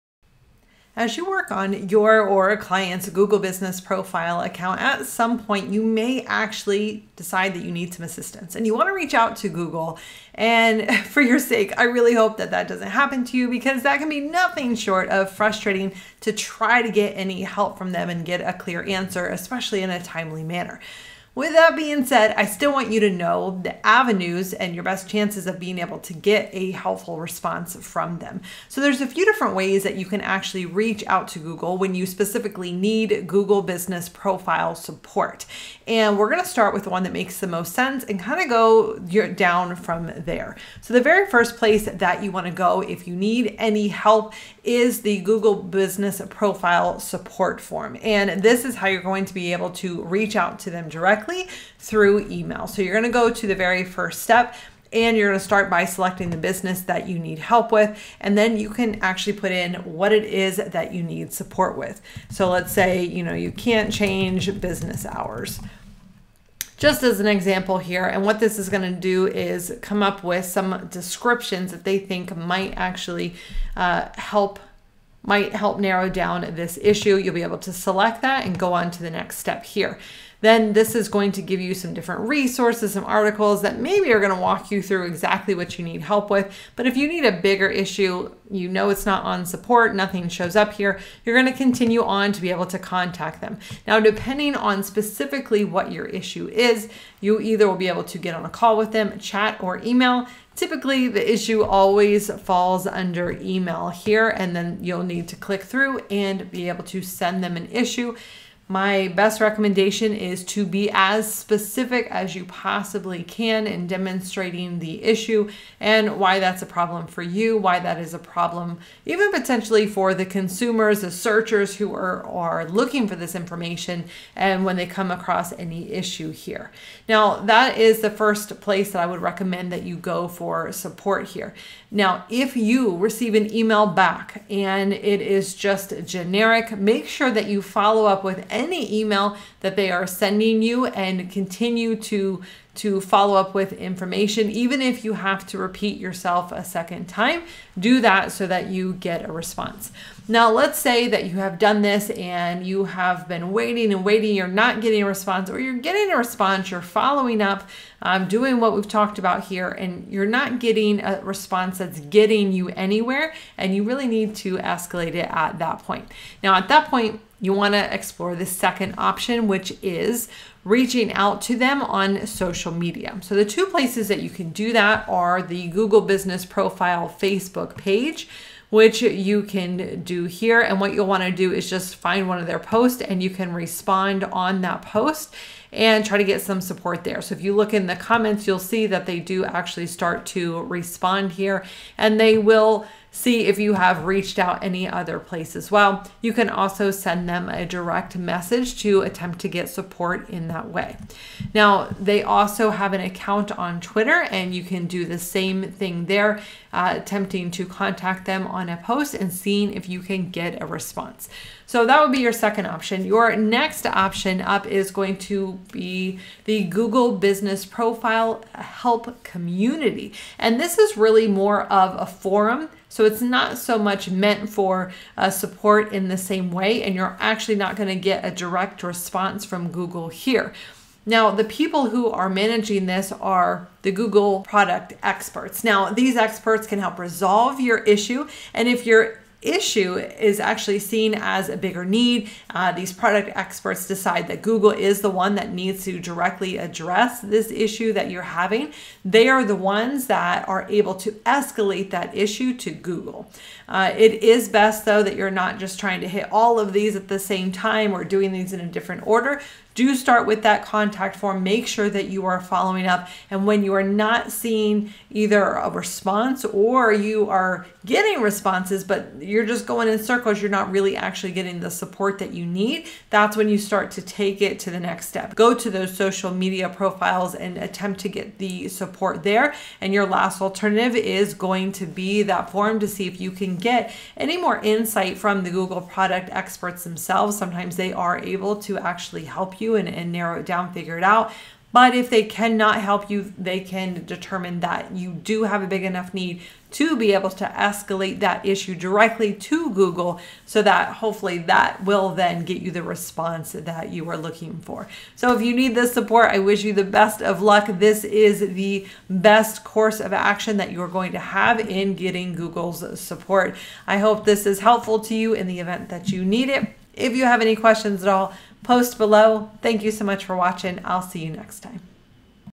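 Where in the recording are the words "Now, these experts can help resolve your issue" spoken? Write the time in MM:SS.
03:55.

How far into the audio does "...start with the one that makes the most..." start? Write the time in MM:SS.
00:36.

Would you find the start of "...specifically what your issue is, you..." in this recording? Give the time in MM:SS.
01:34.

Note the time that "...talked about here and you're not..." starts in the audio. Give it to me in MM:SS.
02:38.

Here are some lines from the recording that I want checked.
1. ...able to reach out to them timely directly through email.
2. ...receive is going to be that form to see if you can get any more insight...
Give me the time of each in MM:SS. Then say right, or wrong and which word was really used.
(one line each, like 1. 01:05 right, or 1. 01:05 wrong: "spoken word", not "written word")
1. 00:49 wrong: "directly", not "timely"
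2. 04:40 wrong: "alternative", not "receive".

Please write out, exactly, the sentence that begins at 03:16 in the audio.
You can also send them a direct message to attempt to get support in that way.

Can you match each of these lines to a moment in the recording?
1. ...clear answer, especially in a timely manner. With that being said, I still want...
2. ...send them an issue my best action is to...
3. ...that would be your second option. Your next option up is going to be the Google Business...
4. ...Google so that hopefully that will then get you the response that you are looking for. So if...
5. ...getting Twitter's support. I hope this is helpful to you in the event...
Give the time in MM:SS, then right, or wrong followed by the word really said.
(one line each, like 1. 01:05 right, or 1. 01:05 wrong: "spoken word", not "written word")
1. 00:18 right
2. 01:47 wrong: "recommendation", not "action"
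3. 03:31 right
4. 04:59 right
5. 05:11 wrong: "Google", not "Twitter".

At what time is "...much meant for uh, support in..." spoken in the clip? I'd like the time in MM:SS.
03:43.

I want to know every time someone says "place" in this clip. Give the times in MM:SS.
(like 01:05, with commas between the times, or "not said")
00:41, 02:08, 02:53, 03:15.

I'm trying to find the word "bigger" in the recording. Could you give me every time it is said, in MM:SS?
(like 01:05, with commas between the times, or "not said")
01:27, 04:01.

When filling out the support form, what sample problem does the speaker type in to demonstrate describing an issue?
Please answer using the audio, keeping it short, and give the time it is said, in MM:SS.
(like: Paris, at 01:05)
can't change business hours, at 01:03.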